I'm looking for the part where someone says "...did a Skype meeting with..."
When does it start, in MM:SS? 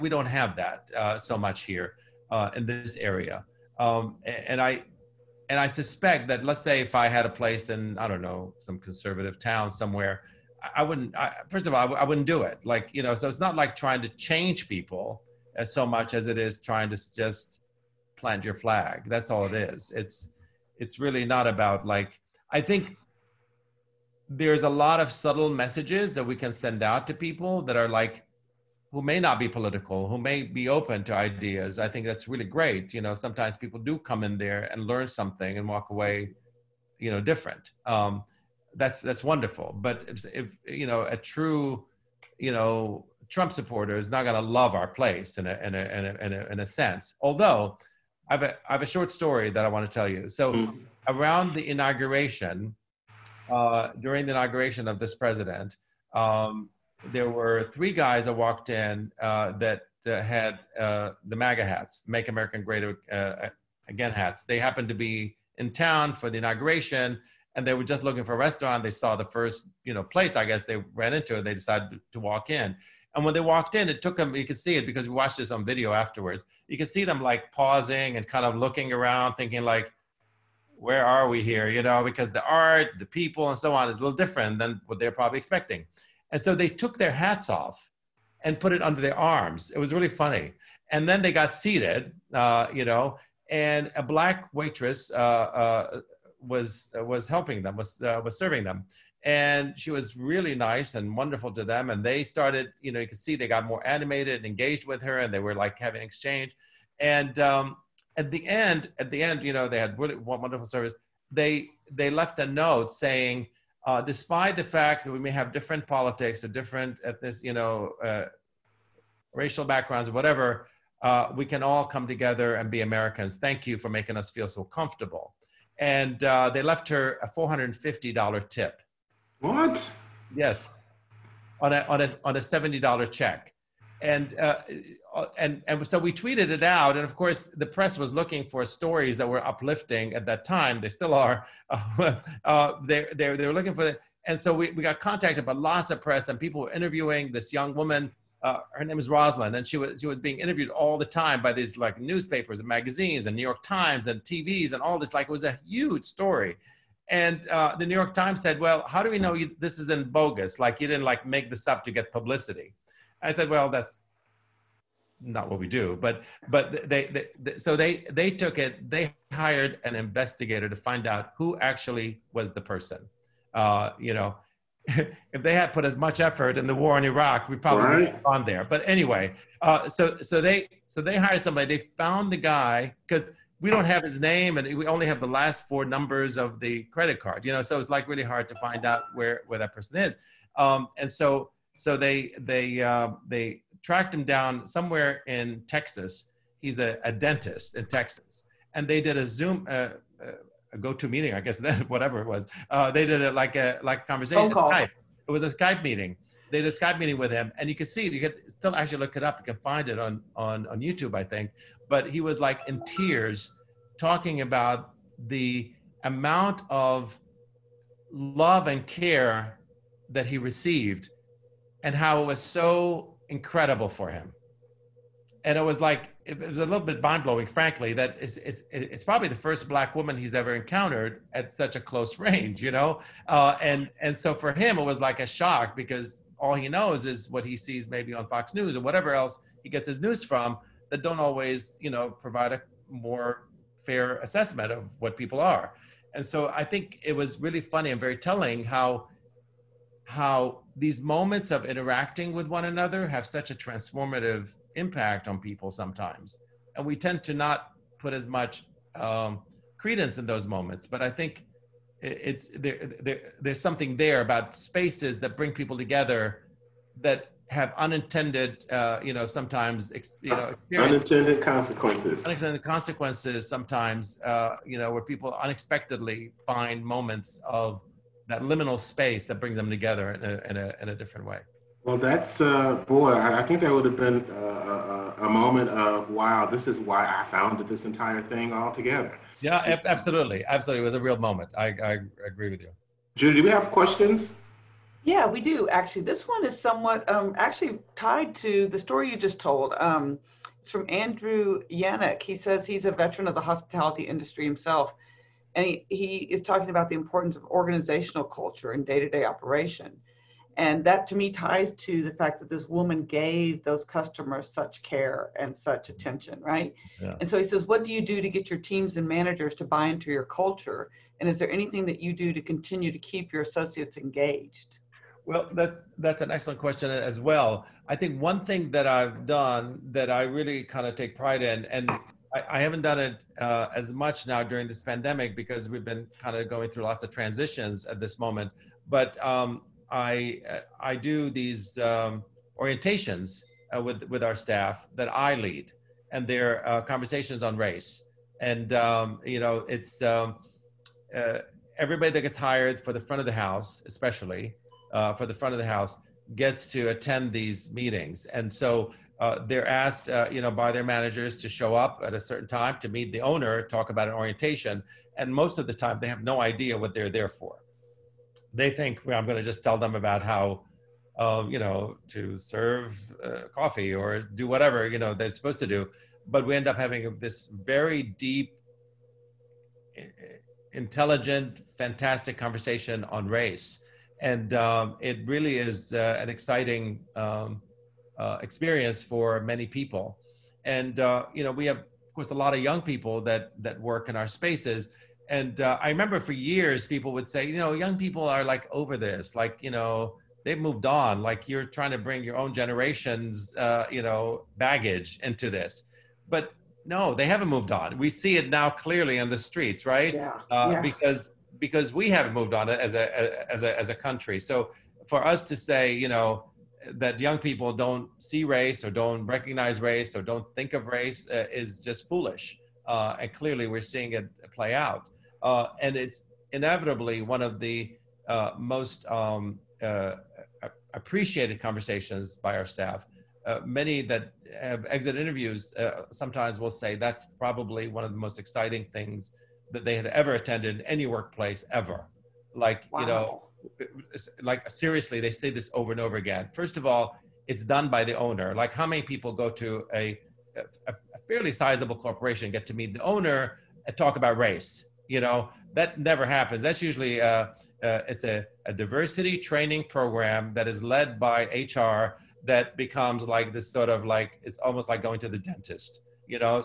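03:26.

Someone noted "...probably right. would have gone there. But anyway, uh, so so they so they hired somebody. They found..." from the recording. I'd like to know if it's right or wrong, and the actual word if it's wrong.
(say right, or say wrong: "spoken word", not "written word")
right.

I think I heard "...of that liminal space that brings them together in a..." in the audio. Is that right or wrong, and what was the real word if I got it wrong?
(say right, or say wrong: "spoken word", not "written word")
right.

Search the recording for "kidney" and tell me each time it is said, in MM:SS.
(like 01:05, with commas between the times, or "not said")
not said.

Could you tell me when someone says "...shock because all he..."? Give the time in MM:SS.
03:55.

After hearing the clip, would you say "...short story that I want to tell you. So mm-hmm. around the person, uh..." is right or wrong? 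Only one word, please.
wrong.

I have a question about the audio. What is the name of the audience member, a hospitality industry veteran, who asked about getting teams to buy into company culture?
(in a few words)
Andrew Yannick.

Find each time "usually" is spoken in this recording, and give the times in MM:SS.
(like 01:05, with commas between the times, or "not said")
07:36.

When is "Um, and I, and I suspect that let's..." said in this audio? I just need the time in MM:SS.
00:03.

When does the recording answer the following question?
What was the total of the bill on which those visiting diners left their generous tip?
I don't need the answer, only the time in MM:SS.
02:12.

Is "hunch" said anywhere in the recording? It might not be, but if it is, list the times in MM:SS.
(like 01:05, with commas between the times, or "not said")
not said.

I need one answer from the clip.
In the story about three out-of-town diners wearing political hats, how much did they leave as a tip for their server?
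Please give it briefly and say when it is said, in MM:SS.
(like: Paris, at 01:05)
$450, at 02:07.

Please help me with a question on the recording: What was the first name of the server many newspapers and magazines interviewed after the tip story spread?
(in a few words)
Rosalind.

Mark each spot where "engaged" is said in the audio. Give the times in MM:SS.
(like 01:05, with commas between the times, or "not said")
01:44, 05:23.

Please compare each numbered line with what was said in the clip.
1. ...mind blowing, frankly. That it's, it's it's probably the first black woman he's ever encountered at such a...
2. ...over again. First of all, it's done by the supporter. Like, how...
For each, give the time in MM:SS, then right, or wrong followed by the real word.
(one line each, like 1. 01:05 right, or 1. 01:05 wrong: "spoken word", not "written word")
1. 03:47 right
2. 07:25 wrong: "owner", not "supporter".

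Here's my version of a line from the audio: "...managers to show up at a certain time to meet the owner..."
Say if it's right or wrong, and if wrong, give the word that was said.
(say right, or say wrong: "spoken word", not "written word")
right.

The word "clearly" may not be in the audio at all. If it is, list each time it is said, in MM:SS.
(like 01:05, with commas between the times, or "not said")
06:48, 07:03.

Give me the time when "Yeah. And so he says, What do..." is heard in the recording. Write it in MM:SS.
05:16.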